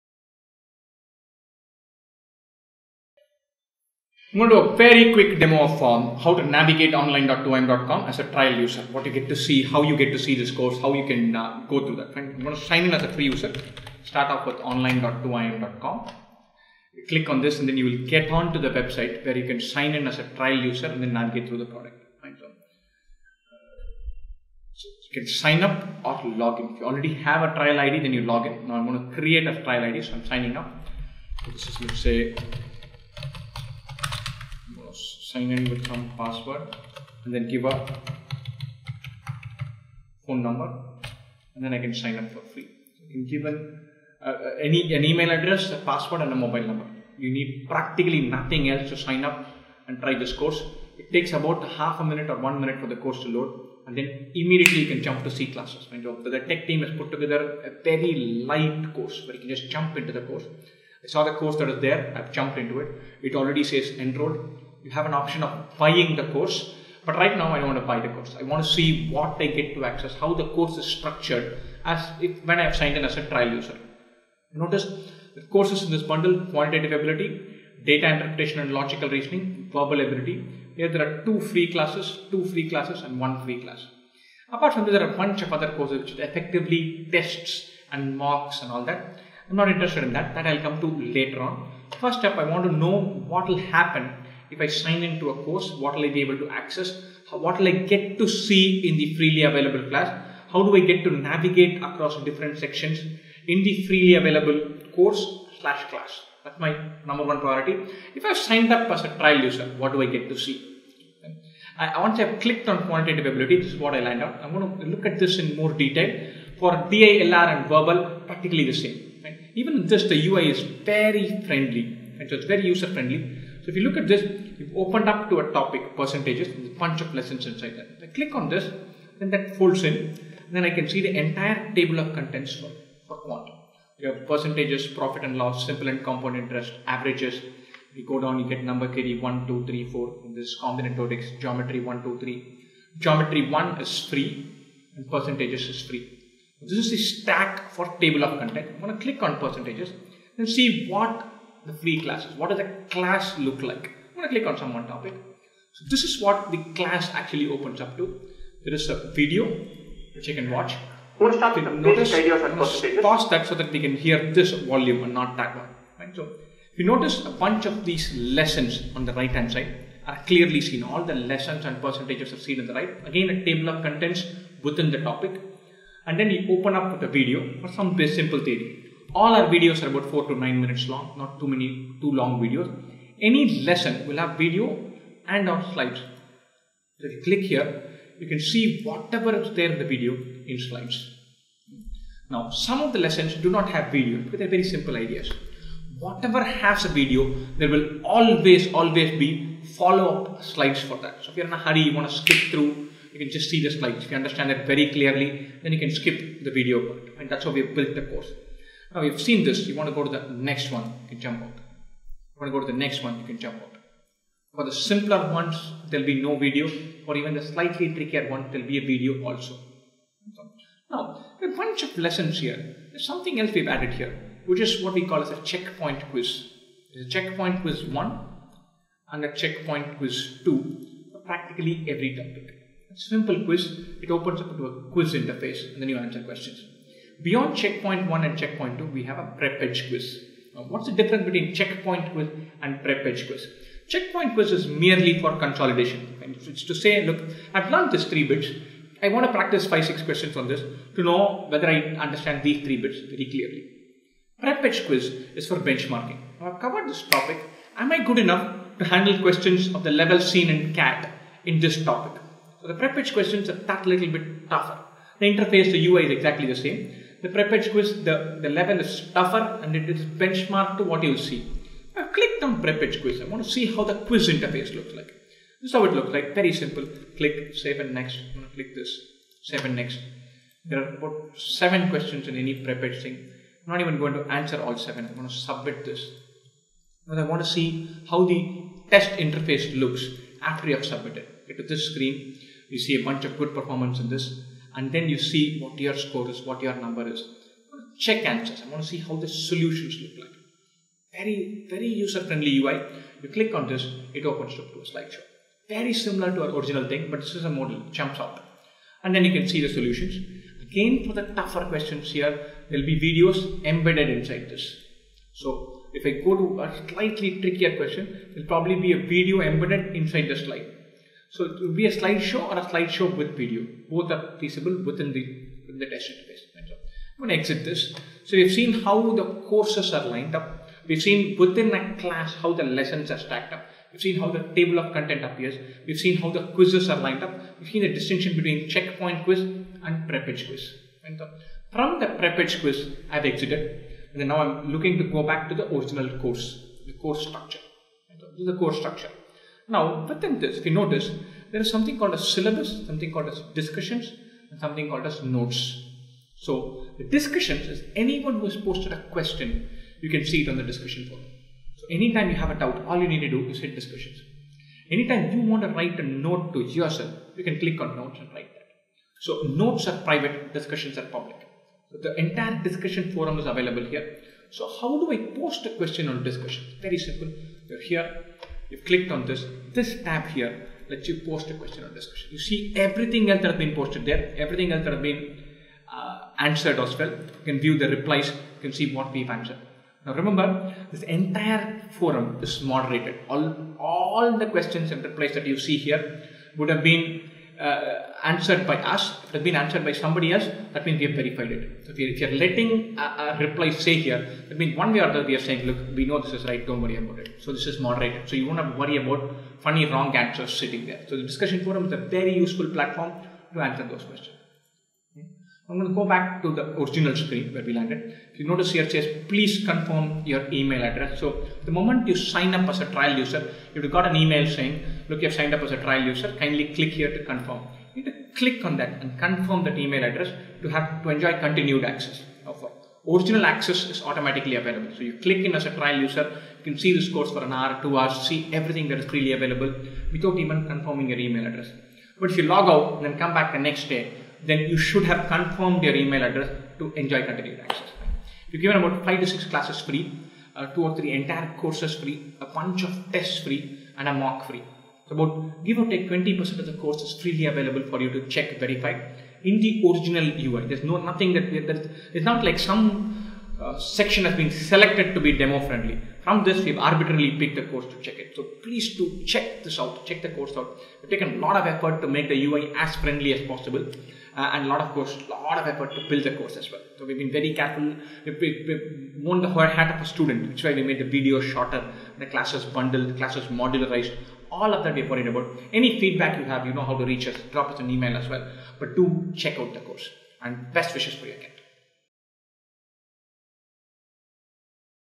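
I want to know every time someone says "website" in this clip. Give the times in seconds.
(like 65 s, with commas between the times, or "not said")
18 s.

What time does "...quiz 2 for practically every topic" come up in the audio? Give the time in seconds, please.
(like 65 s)
229 s.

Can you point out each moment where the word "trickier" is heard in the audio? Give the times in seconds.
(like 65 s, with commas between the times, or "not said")
217 s, 317 s.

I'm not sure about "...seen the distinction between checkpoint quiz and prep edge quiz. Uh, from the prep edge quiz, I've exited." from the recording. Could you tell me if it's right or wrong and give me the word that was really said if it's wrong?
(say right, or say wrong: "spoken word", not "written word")
right.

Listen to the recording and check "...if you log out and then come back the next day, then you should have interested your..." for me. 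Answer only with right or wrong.
wrong.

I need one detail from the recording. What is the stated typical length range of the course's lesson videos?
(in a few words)
4 to 9 minutes.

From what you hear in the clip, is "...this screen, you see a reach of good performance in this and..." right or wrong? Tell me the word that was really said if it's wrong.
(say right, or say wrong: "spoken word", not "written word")
wrong: "bunch", not "reach".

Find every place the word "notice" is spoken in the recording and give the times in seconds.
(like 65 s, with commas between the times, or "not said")
74 s, 161 s, 166 s, 350 s, 418 s.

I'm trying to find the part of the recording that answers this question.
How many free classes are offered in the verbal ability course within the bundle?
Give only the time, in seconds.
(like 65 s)
83 s.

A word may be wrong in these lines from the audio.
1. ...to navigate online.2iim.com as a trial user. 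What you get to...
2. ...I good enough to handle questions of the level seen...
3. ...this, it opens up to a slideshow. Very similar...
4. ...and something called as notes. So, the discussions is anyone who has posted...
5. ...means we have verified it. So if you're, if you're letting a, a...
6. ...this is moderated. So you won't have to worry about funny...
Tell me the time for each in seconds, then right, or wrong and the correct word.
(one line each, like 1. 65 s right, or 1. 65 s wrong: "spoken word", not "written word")
1. 6 s right
2. 257 s right
3. 303 s right
4. 354 s right
5. 400 s right
6. 407 s right.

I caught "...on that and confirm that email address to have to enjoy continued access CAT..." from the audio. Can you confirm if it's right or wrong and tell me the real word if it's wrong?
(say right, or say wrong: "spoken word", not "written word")
wrong: "Original", not "CAT".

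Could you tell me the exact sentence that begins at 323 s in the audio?
Both are feasible within the, within the test interface.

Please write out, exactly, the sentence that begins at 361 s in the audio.
So, anytime you have a doubt, all you need to do is hit discussions.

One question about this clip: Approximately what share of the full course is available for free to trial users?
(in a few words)
20%.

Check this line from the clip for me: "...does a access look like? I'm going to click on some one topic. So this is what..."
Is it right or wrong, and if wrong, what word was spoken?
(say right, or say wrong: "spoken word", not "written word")
wrong: "class", not "access".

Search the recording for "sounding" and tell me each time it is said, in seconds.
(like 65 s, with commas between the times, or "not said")
not said.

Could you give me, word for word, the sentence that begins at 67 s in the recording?
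But right now, I don't want to buy the course.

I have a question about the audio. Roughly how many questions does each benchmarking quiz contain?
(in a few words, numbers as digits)
7.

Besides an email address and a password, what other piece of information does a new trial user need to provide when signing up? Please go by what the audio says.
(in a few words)
Mobile number.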